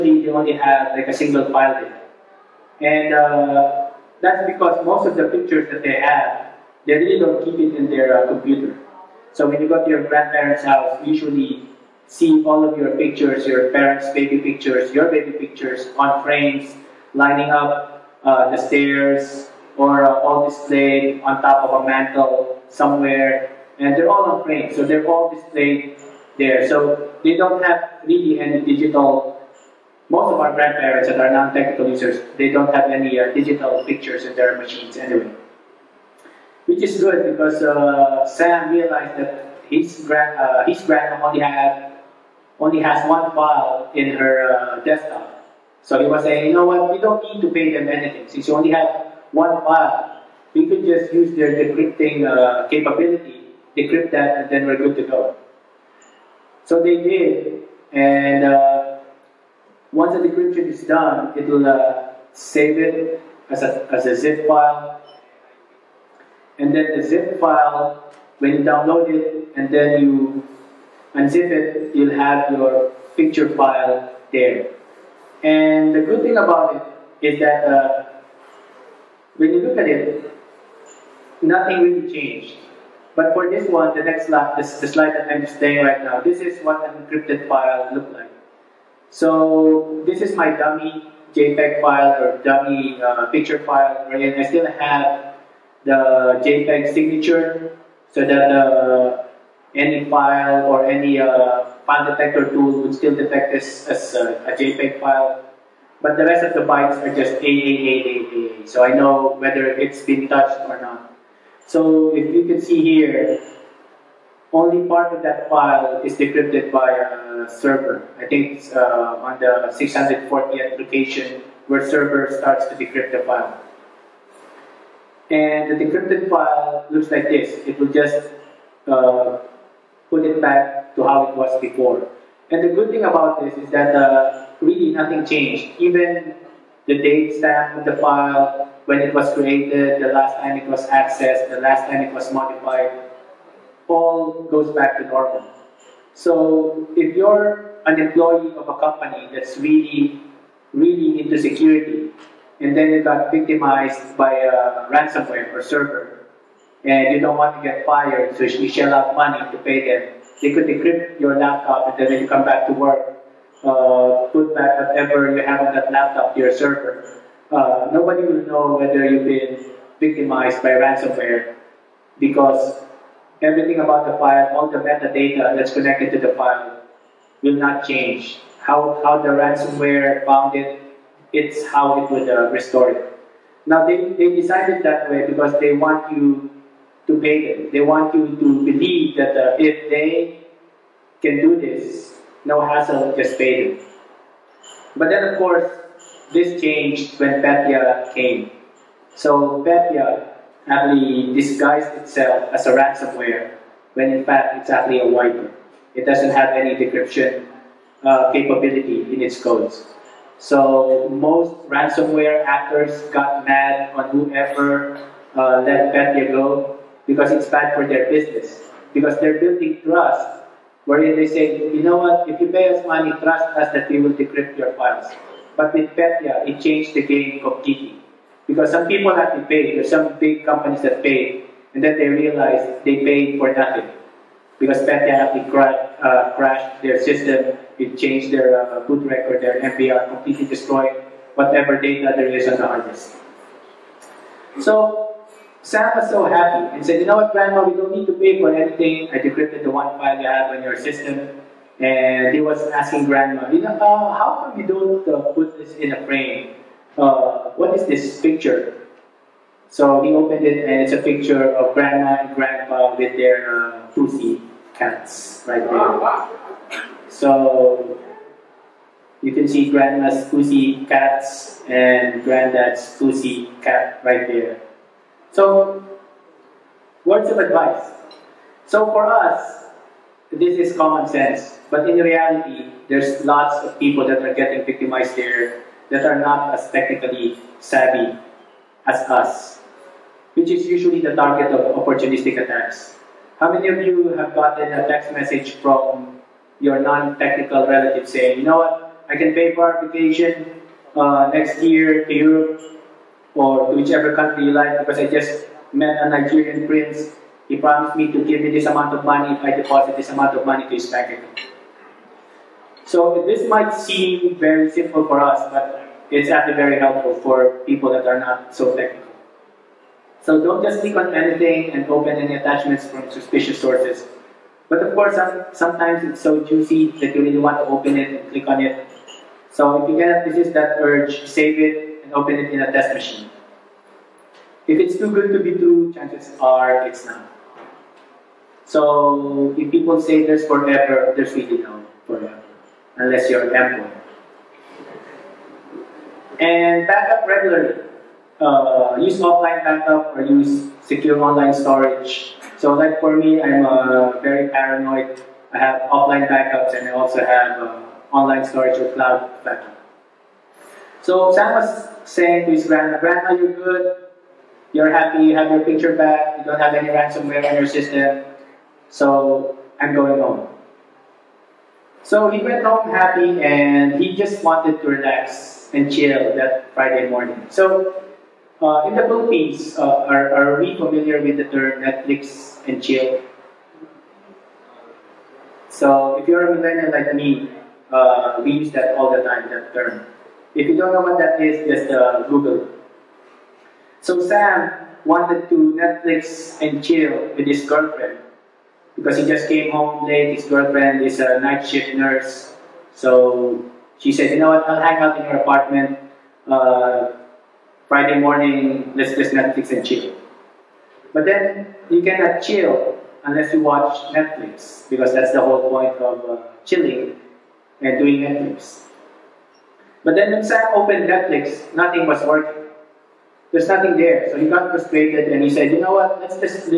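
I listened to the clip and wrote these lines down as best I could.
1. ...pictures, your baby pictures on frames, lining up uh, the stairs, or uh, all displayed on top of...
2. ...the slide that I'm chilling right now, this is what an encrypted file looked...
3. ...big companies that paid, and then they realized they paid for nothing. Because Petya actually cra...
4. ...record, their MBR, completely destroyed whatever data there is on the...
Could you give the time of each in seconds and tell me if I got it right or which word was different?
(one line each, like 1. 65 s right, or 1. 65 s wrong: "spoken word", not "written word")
1. 14 s right
2. 84 s wrong: "displaying", not "chilling"
3. 230 s right
4. 239 s right.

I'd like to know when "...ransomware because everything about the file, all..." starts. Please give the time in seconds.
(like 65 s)
170 s.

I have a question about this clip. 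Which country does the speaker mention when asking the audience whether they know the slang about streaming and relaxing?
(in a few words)
Philippines.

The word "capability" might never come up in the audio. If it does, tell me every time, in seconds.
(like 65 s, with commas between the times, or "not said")
52 s, 208 s.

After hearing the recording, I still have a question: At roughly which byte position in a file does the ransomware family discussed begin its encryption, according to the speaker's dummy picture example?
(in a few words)
640th.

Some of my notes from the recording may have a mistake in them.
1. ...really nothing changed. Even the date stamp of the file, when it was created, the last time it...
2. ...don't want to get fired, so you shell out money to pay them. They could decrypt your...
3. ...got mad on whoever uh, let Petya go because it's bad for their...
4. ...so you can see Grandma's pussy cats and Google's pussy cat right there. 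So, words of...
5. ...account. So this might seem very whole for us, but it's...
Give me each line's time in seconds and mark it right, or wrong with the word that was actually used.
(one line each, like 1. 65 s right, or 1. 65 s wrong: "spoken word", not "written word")
1. 134 s right
2. 157 s right
3. 213 s right
4. 267 s wrong: "Granddad", not "Google"
5. 311 s wrong: "simple", not "whole".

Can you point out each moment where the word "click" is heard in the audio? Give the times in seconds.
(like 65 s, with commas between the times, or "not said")
320 s, 328 s.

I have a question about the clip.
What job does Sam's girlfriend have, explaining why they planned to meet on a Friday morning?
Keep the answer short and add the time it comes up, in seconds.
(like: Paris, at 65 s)
night shift nurse, at 401 s.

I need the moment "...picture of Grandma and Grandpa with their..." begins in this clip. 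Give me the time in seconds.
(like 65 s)
261 s.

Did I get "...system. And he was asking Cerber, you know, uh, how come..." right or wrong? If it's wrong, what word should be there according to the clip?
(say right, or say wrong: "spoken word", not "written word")
wrong: "Grandma", not "Cerber".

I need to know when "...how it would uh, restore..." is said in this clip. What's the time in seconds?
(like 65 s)
181 s.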